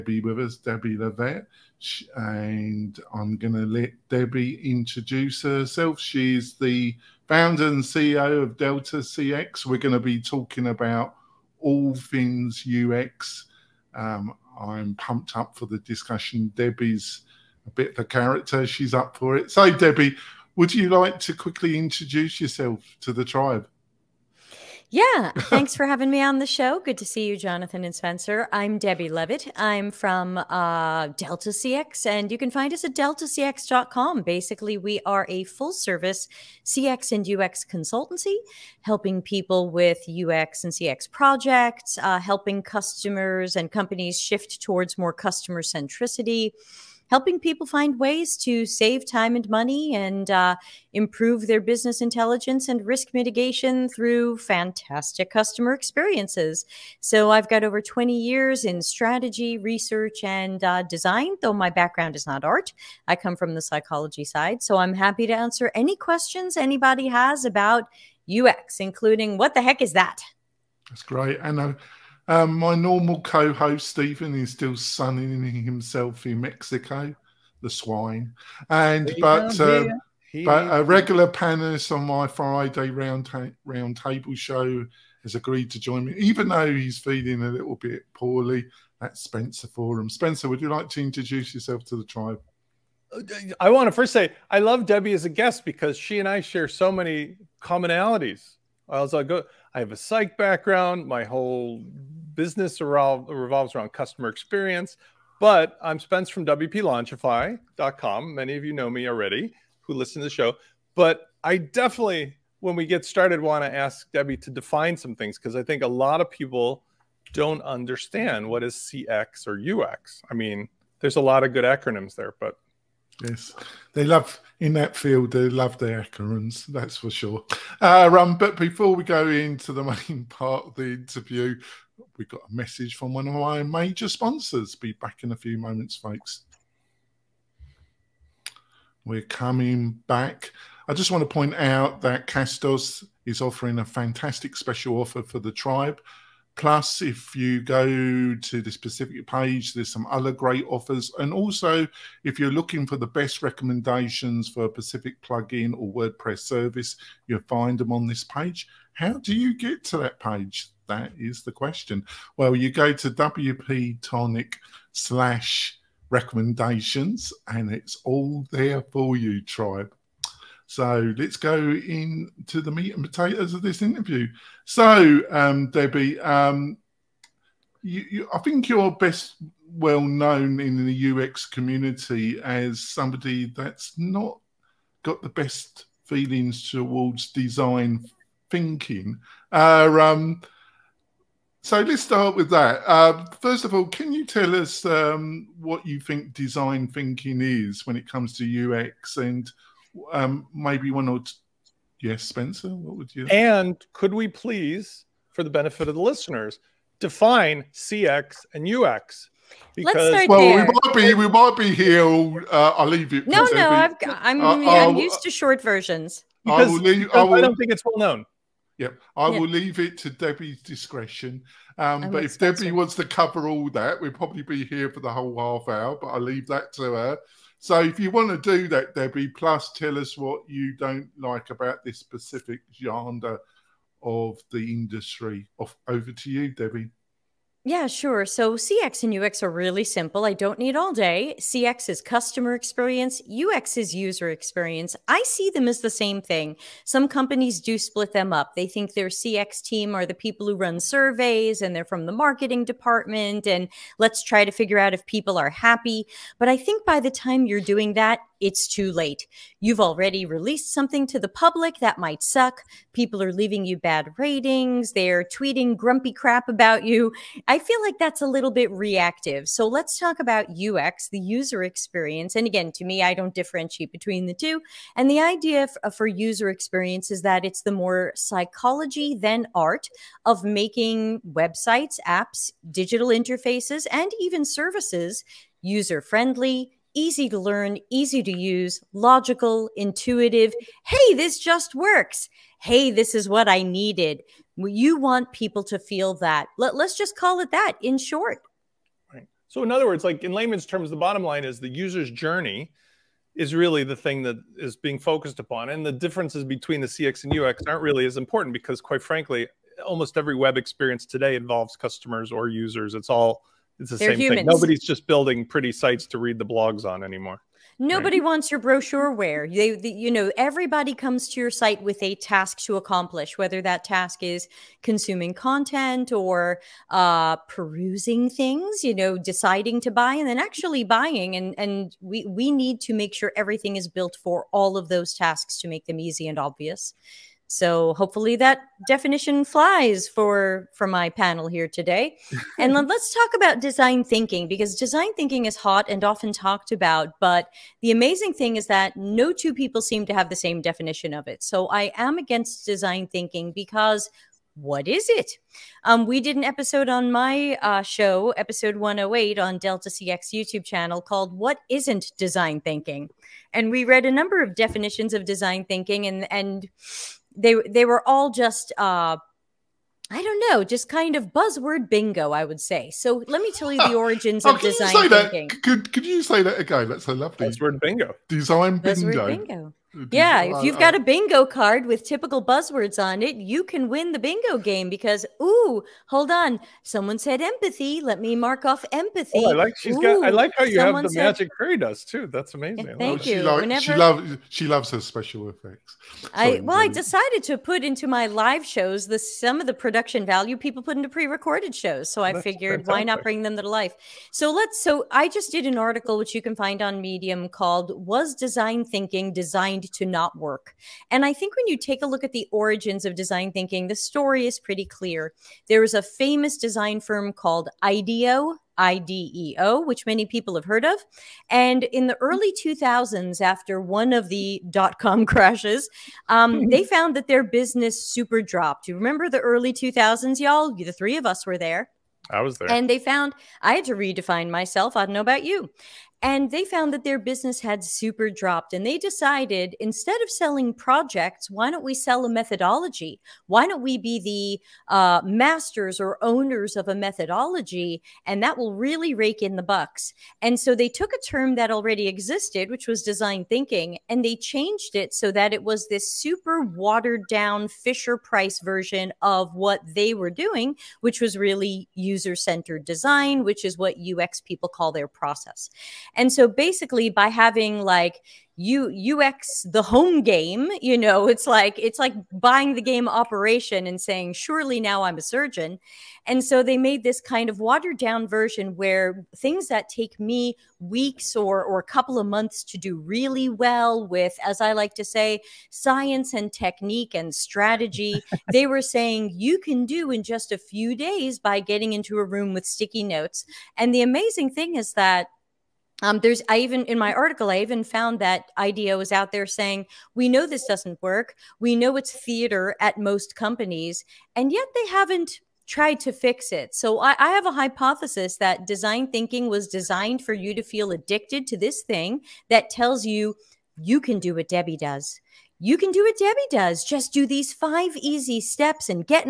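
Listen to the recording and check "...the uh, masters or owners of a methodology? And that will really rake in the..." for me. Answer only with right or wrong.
right.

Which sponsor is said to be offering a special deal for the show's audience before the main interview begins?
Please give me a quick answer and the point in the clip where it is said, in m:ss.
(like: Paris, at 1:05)
Castos, at 2:22.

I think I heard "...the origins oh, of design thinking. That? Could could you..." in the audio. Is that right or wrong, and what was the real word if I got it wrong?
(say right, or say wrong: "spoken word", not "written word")
right.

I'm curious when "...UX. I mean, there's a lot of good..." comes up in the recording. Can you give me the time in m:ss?
1:59.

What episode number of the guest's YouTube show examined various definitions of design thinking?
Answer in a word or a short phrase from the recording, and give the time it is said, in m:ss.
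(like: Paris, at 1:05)
108, at 5:58.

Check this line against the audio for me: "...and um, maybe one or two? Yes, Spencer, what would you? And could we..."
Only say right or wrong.
right.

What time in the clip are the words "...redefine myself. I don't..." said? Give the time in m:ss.
7:13.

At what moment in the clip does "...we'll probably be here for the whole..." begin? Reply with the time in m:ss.
3:44.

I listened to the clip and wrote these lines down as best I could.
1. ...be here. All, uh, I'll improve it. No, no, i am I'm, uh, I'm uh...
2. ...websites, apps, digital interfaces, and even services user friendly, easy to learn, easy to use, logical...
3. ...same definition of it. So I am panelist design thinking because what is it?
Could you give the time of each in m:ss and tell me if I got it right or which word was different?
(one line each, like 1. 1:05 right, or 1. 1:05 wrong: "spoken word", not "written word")
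1. 3:31 wrong: "leave", not "improve"
2. 4:41 right
3. 5:50 wrong: "against", not "panelist".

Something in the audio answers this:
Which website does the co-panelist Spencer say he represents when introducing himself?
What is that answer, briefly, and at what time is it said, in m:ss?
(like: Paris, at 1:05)
WPLaunchify.com, at 1:46.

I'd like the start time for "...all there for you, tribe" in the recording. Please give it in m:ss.
2:48.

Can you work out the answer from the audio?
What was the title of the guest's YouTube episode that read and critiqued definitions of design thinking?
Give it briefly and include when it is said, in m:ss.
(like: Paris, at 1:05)
What Isn't Design Thinking?, at 6:01.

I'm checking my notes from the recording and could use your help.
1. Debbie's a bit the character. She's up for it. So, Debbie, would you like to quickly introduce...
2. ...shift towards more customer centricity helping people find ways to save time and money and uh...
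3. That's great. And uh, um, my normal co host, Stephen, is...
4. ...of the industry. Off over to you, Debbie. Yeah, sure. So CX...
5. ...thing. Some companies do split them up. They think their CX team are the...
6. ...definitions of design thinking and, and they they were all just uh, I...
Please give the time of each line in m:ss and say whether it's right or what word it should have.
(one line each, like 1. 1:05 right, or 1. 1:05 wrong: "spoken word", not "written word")
1. 0:16 right
2. 0:44 right
3. 1:10 right
4. 3:54 right
5. 4:06 right
6. 6:04 right.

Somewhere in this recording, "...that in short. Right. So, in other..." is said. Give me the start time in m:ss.
4:57.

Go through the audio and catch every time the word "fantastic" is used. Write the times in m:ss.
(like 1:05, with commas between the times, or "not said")
0:54, 2:23, 6:42.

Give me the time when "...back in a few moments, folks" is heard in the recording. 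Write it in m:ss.
2:14.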